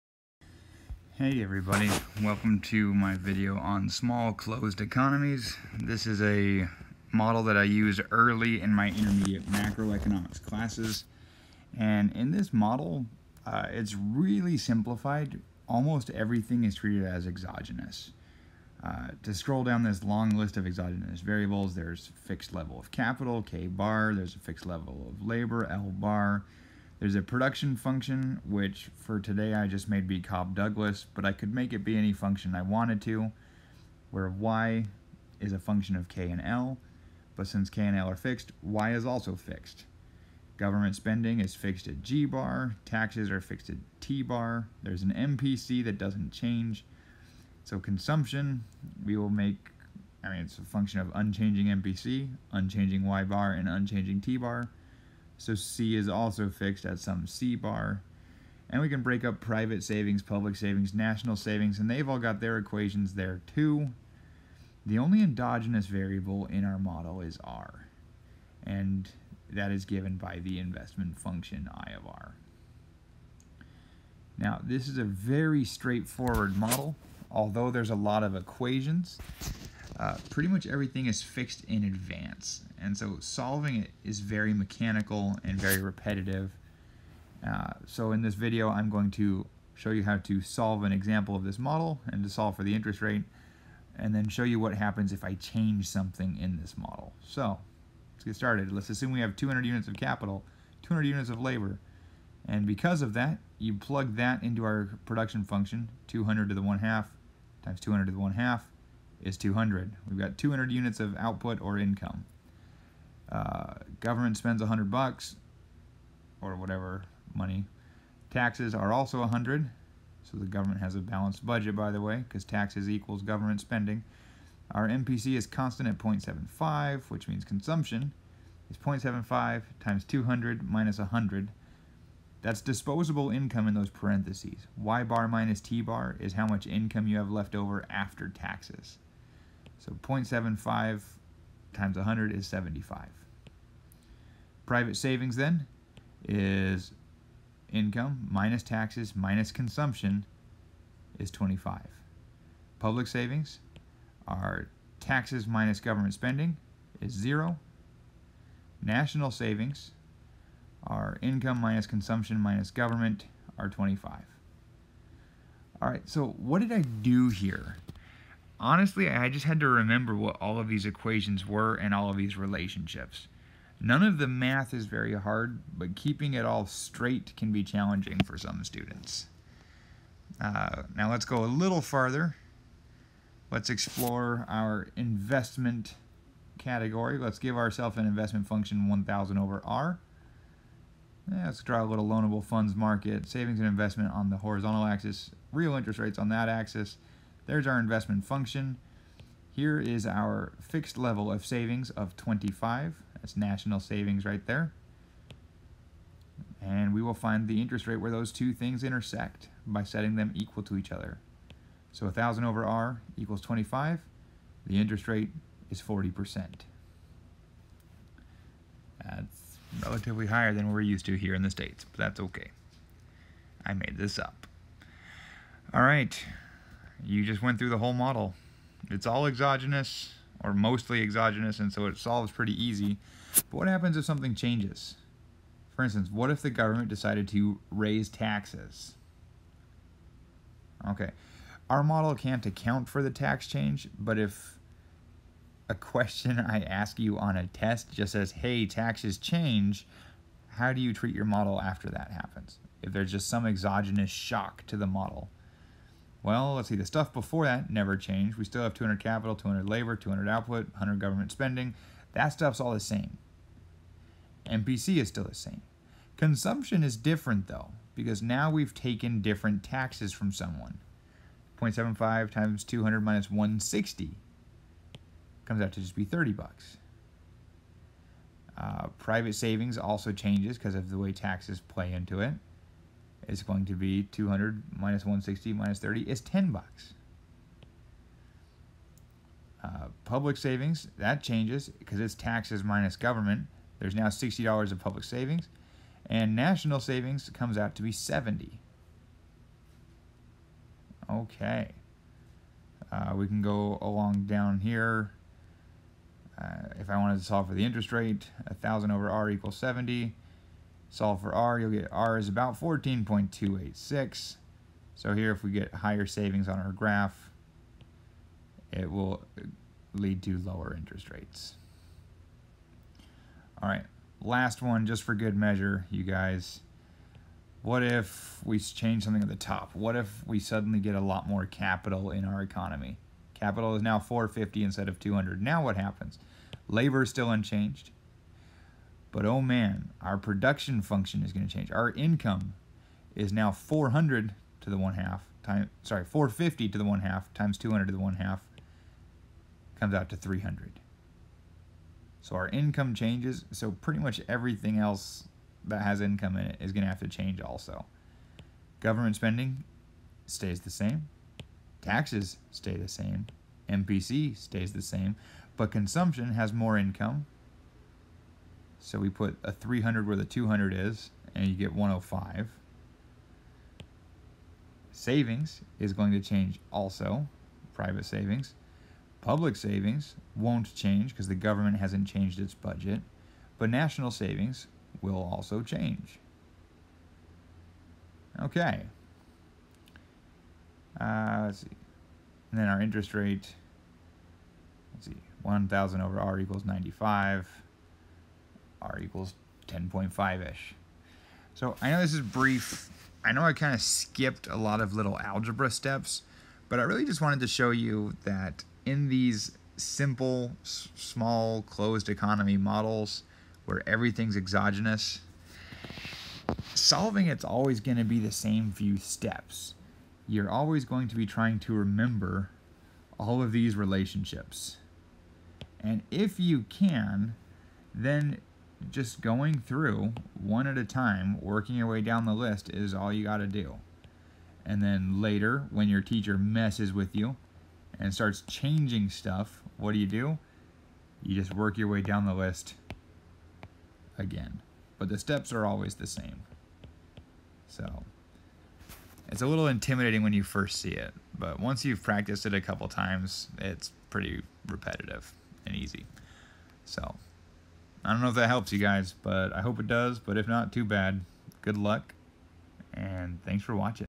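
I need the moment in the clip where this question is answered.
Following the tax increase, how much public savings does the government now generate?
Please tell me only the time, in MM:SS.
04:54.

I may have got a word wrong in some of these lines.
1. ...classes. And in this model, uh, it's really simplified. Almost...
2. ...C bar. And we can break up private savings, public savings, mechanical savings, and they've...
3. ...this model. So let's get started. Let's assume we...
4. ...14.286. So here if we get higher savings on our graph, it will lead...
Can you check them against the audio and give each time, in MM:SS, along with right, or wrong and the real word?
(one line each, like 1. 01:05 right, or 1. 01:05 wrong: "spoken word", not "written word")
1. 00:10 right
2. 00:57 wrong: "national", not "mechanical"
3. 01:36 right
4. 05:12 right.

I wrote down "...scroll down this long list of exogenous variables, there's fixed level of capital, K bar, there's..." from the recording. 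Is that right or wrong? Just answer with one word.
right.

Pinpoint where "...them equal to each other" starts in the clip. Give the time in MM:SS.
03:30.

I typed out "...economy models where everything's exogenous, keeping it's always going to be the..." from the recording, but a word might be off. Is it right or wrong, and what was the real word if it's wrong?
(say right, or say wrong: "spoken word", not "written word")
wrong: "solving", not "keeping".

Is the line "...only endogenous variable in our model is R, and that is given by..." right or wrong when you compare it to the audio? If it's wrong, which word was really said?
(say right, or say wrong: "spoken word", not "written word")
right.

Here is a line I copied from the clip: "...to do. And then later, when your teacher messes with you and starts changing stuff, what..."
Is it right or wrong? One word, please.
right.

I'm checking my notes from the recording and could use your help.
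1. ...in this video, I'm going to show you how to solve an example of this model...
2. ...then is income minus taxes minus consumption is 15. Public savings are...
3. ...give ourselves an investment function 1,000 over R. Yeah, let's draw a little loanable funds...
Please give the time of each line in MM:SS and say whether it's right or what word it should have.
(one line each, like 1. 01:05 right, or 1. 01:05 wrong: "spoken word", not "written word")
1. 01:28 right
2. 02:25 wrong: "25", not "15"
3. 03:07 right.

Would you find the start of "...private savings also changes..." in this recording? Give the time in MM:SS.
04:38.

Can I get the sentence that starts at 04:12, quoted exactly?
If there's just some exogenous shock to the model.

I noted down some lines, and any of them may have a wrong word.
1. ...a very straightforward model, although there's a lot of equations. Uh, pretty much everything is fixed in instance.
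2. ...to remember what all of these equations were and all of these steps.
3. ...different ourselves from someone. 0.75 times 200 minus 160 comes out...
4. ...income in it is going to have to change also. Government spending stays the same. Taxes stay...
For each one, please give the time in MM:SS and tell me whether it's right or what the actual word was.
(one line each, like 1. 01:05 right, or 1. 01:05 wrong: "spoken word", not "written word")
1. 01:14 wrong: "advance", not "instance"
2. 02:49 wrong: "relationships", not "steps"
3. 04:29 wrong: "taxes", not "ourselves"
4. 05:55 right.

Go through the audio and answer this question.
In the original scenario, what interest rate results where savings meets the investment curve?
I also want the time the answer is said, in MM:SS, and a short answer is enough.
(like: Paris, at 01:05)
40%, at 03:35.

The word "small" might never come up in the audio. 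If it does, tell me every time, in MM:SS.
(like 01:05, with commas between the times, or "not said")
00:03, 06:50.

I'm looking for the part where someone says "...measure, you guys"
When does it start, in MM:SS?
05:25.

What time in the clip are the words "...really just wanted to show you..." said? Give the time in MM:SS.
06:46.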